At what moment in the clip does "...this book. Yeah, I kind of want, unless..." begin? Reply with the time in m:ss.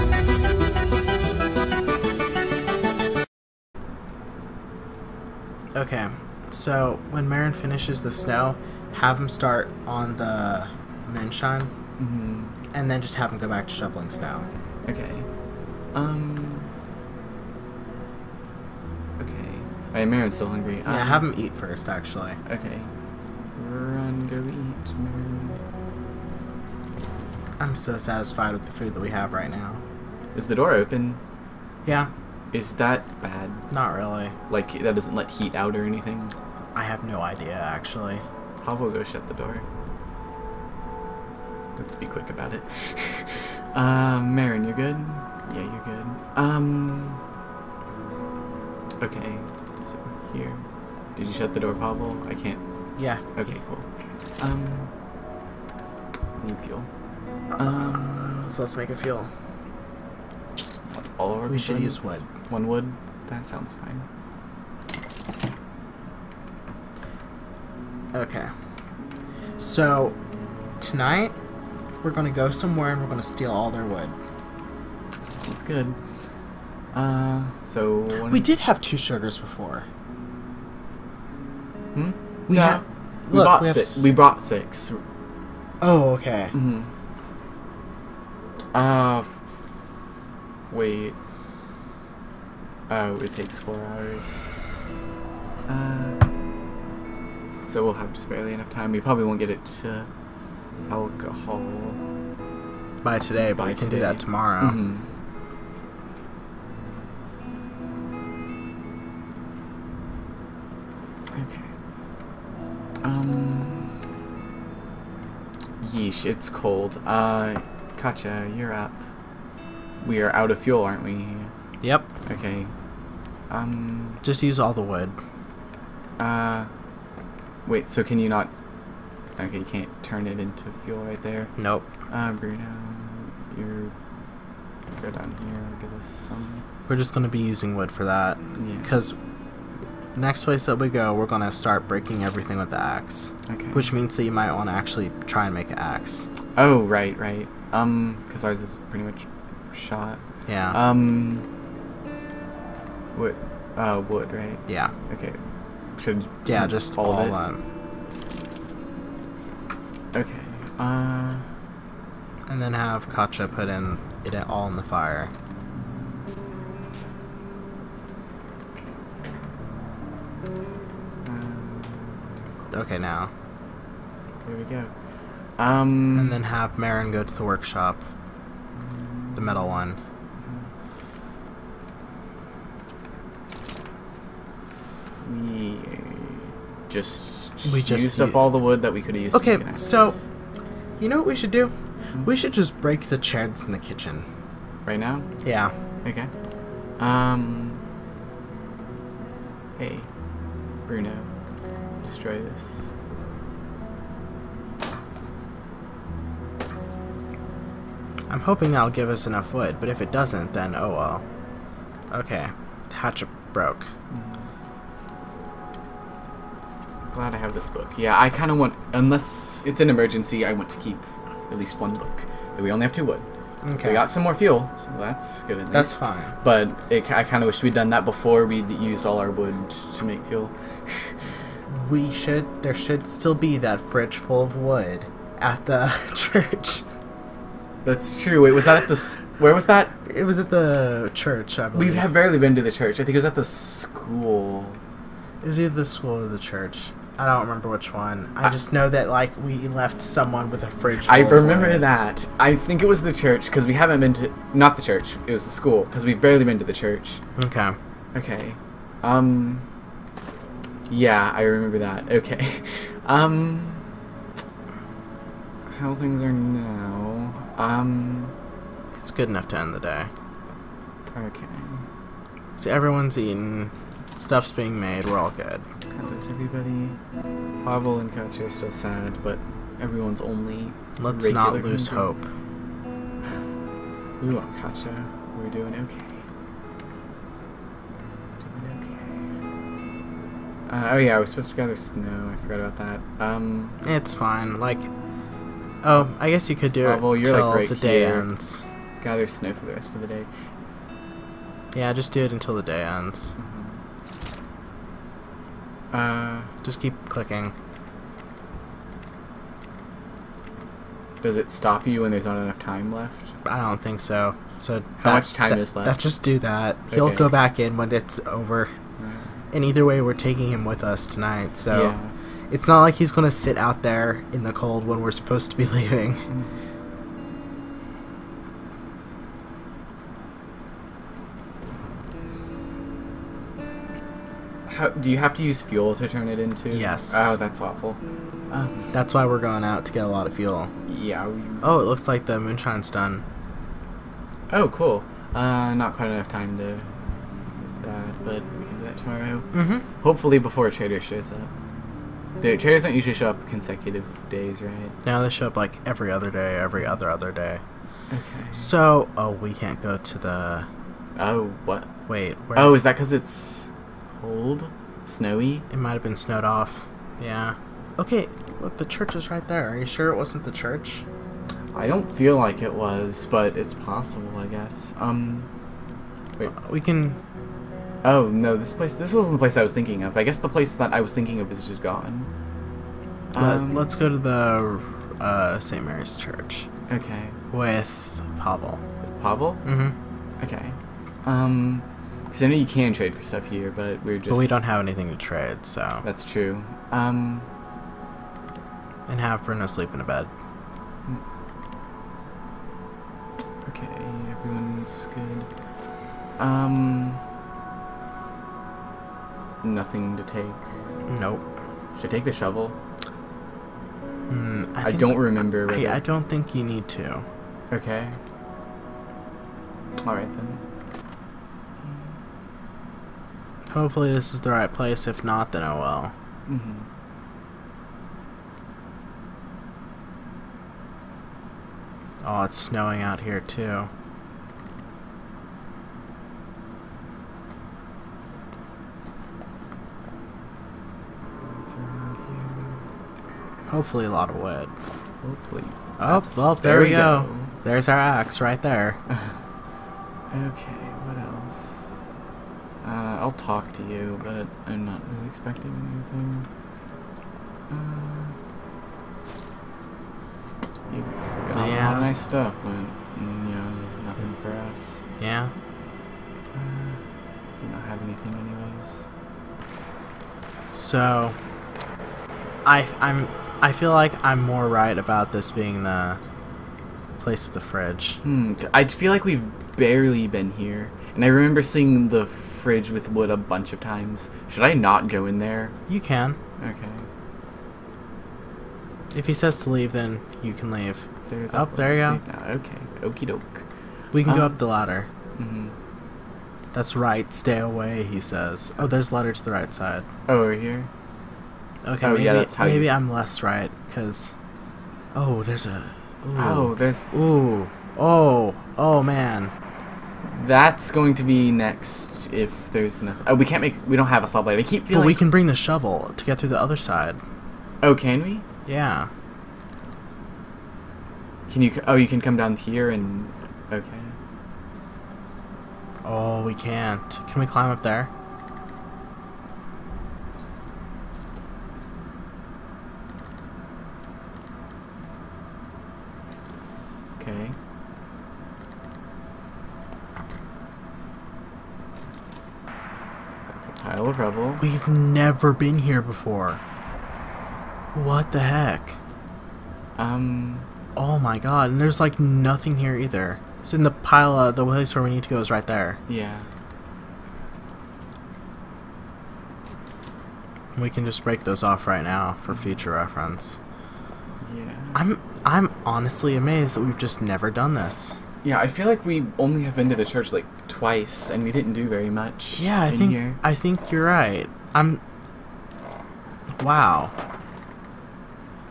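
3:37.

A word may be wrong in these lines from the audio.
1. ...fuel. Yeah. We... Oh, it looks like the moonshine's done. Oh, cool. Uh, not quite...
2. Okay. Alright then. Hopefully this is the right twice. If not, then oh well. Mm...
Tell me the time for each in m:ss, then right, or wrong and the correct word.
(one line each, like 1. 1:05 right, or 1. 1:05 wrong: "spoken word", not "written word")
1. 5:40 right
2. 6:57 wrong: "place", not "twice".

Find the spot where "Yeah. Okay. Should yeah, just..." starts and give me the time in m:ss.
2:34.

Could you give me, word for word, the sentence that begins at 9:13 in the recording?
It's in the pile of the place where we need to go is right there.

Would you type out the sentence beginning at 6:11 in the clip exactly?
I don't feel like it was, but it's possible, I guess.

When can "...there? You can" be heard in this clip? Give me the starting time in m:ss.
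8:05.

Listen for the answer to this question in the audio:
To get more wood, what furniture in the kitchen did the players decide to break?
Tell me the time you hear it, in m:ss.
3:13.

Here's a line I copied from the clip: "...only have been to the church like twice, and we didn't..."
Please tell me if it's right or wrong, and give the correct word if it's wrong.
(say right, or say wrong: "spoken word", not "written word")
right.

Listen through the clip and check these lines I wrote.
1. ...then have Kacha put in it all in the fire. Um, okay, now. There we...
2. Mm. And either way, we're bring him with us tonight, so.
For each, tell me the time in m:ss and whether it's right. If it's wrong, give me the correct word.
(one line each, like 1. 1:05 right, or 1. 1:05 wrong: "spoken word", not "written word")
1. 2:42 right
2. 5:18 wrong: "taking", not "bring".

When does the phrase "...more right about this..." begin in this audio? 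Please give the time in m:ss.
7:54.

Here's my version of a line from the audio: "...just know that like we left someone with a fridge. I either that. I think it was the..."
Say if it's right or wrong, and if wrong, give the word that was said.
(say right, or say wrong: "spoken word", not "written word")
wrong: "remember", not "either".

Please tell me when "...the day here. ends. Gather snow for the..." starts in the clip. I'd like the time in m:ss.
4:57.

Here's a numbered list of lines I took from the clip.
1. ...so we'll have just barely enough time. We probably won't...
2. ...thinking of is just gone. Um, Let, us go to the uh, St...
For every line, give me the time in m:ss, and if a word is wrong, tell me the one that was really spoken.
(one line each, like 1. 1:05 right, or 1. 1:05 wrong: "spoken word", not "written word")
1. 1:37 right
2. 6:21 right.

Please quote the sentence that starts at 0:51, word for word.
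Did you shut the door, Pavel?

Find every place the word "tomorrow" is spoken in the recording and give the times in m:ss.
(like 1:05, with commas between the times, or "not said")
1:44, 5:48.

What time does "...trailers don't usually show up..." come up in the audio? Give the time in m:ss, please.
5:52.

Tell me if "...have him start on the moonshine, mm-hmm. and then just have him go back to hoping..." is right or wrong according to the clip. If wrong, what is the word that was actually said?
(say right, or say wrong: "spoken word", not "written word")
wrong: "shoveling", not "hoping".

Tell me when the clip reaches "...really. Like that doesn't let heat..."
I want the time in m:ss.
0:33.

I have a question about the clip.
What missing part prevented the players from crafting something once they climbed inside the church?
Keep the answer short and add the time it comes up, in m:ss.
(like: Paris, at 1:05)
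A saw blade, at 8:34.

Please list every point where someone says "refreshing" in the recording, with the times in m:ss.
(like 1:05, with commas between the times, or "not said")
not said.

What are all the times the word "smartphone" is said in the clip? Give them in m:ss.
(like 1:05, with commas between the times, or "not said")
not said.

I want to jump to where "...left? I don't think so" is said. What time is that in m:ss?
5:12.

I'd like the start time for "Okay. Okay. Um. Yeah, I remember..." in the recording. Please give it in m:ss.
4:17.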